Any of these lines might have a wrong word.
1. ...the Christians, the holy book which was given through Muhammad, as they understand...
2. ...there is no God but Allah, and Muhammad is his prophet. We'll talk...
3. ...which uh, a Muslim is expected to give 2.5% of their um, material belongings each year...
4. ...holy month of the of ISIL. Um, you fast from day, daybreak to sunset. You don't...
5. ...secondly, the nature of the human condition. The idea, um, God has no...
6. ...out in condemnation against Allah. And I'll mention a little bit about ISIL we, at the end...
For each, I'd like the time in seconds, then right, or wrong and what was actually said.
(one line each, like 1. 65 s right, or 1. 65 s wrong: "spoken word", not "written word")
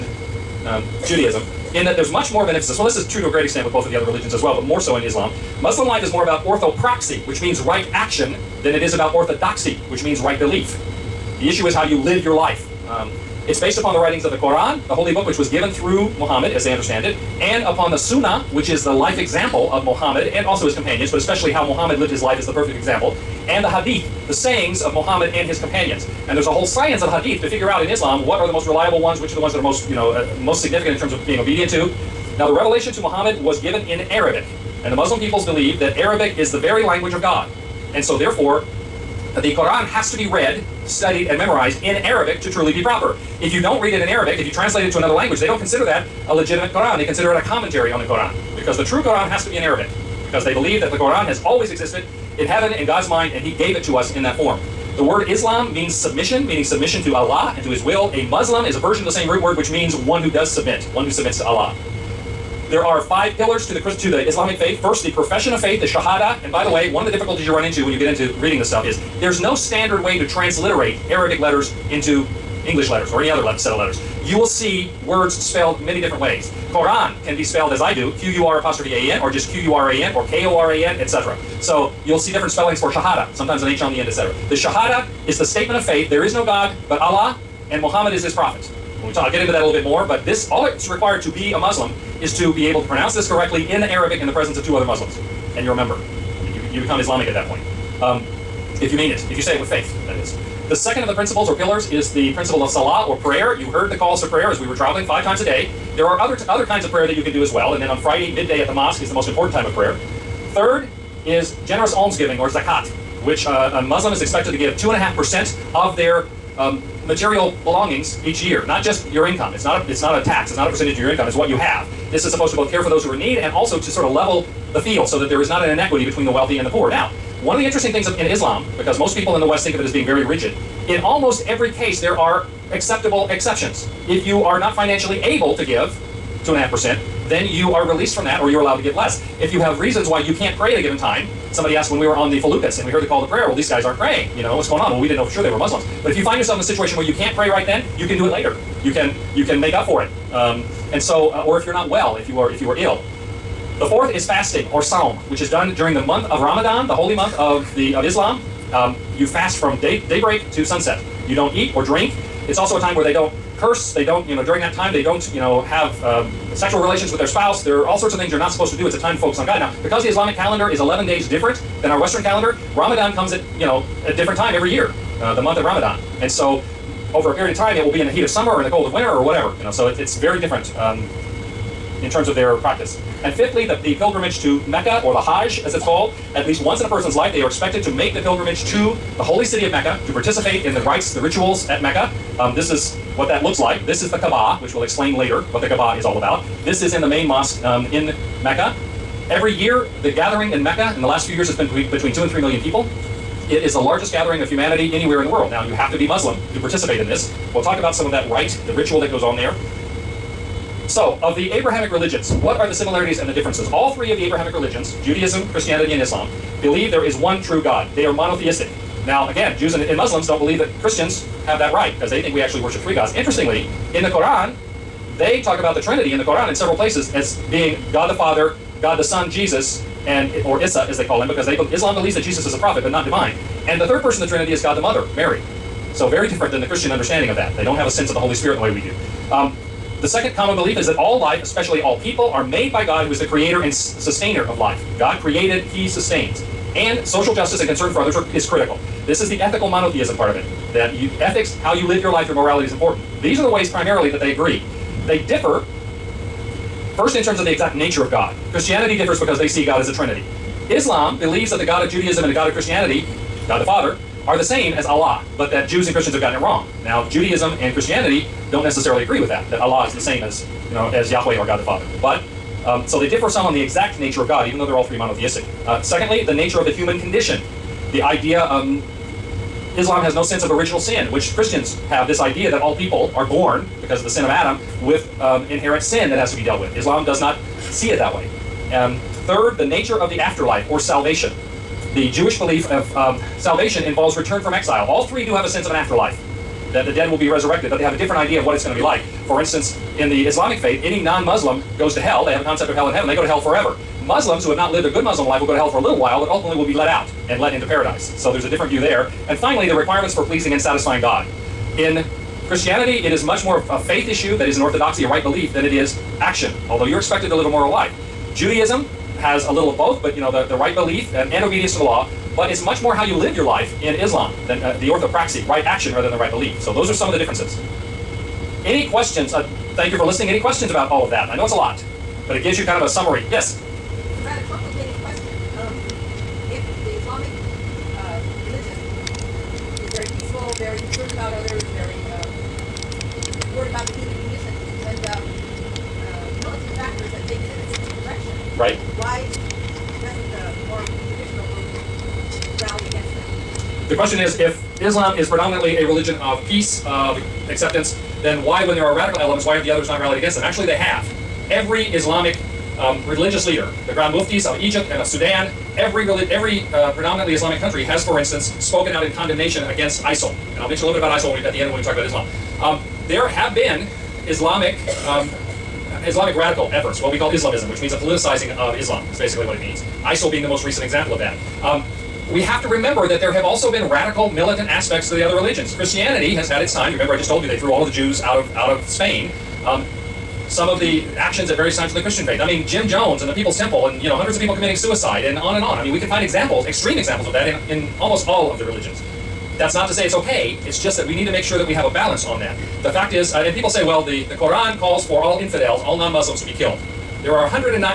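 1. 14 s wrong: "Quran", not "Christians"
2. 86 s right
3. 113 s right
4. 156 s wrong: "Islam", not "ISIL"
5. 275 s wrong: "Islam", not "God"
6. 368 s wrong: "ISIL", not "Allah".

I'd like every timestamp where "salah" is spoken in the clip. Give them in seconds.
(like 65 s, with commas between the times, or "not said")
102 s.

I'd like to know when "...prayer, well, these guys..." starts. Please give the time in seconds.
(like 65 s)
143 s.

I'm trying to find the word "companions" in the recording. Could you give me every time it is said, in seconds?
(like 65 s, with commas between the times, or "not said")
20 s, 25 s.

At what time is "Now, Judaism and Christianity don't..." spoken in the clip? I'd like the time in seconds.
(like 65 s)
266 s.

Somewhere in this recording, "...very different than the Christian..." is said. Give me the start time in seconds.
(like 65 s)
236 s.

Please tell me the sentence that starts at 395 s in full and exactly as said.
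I mean, we can find examples, extreme examples of that, in in almost all of the religions.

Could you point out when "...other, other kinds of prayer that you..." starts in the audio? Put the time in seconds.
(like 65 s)
106 s.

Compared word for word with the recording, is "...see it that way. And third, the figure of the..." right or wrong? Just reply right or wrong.
wrong.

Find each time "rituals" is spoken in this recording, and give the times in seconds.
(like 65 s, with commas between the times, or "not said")
191 s, 208 s.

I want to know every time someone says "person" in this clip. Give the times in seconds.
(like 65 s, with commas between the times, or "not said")
186 s, 234 s.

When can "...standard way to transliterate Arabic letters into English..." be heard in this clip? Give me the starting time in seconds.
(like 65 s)
69 s.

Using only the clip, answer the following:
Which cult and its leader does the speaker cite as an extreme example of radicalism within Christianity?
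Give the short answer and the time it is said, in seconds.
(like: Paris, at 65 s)
Jim Jones and the People's Temple, at 392 s.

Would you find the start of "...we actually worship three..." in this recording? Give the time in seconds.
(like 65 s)
222 s.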